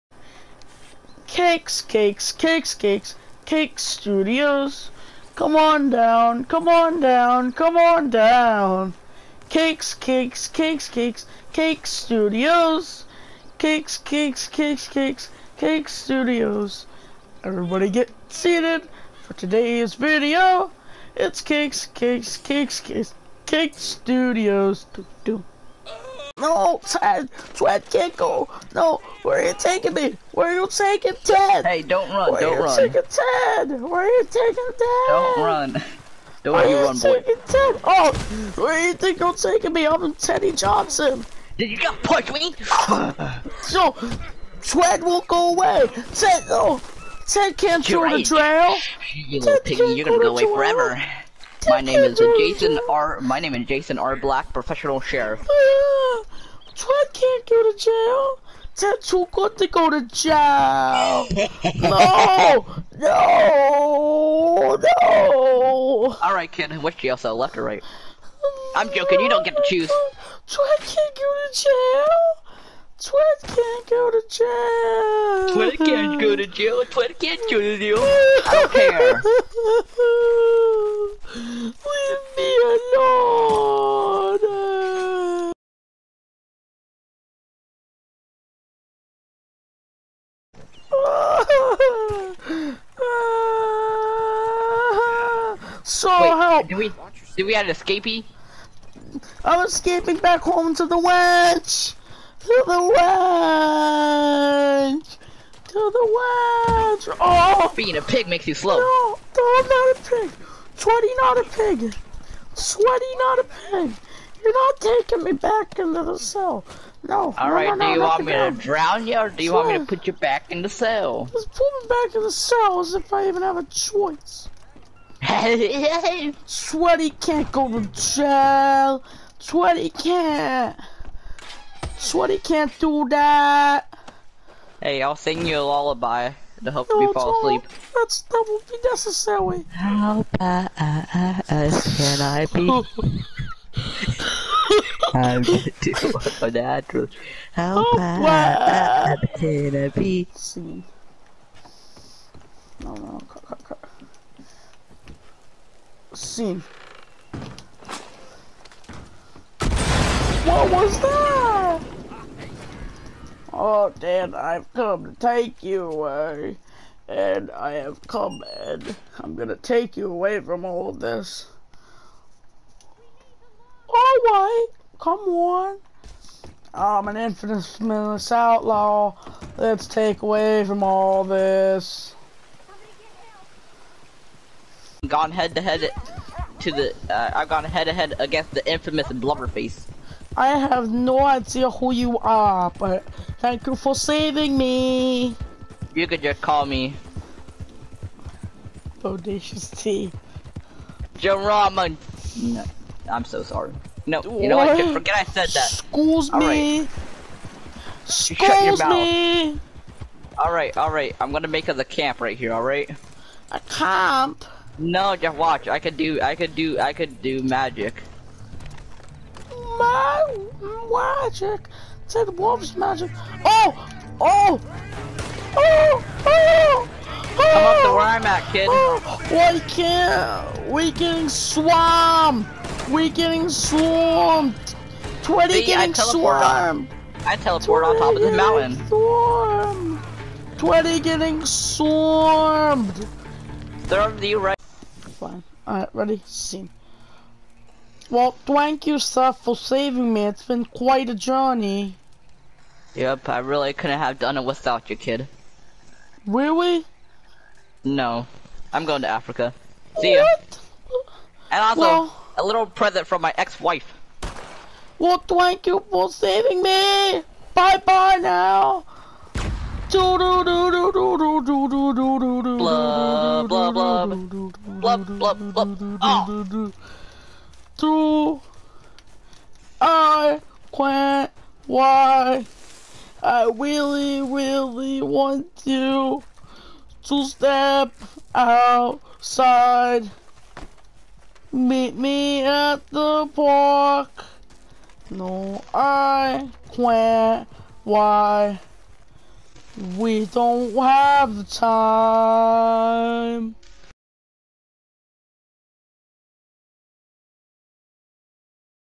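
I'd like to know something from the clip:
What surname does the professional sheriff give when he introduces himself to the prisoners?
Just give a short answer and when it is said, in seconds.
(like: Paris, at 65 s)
Black, at 54 s.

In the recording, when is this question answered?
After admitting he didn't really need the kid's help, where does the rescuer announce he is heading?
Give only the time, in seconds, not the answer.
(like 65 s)
259 s.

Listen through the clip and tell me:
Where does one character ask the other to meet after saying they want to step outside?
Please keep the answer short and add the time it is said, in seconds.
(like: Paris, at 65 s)
the park, at 292 s.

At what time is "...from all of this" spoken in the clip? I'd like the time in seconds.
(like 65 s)
170 s.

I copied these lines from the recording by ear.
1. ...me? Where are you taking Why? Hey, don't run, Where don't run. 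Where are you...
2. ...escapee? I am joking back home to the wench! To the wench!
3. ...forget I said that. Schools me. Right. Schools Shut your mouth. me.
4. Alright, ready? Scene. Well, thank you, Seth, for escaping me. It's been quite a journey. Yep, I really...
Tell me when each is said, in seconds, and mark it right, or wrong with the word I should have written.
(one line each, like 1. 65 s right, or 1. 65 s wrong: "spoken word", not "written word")
1. 29 s wrong: "Ted", not "Why"
2. 97 s wrong: "escaping", not "joking"
3. 204 s right
4. 245 s wrong: "saving", not "escaping".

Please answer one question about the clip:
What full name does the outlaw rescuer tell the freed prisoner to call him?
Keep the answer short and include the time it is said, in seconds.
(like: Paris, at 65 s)
Bodacious T. Jerome, at 199 s.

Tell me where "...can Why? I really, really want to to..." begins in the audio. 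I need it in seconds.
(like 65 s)
280 s.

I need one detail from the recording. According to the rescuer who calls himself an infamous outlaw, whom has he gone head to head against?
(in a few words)
Blubberface.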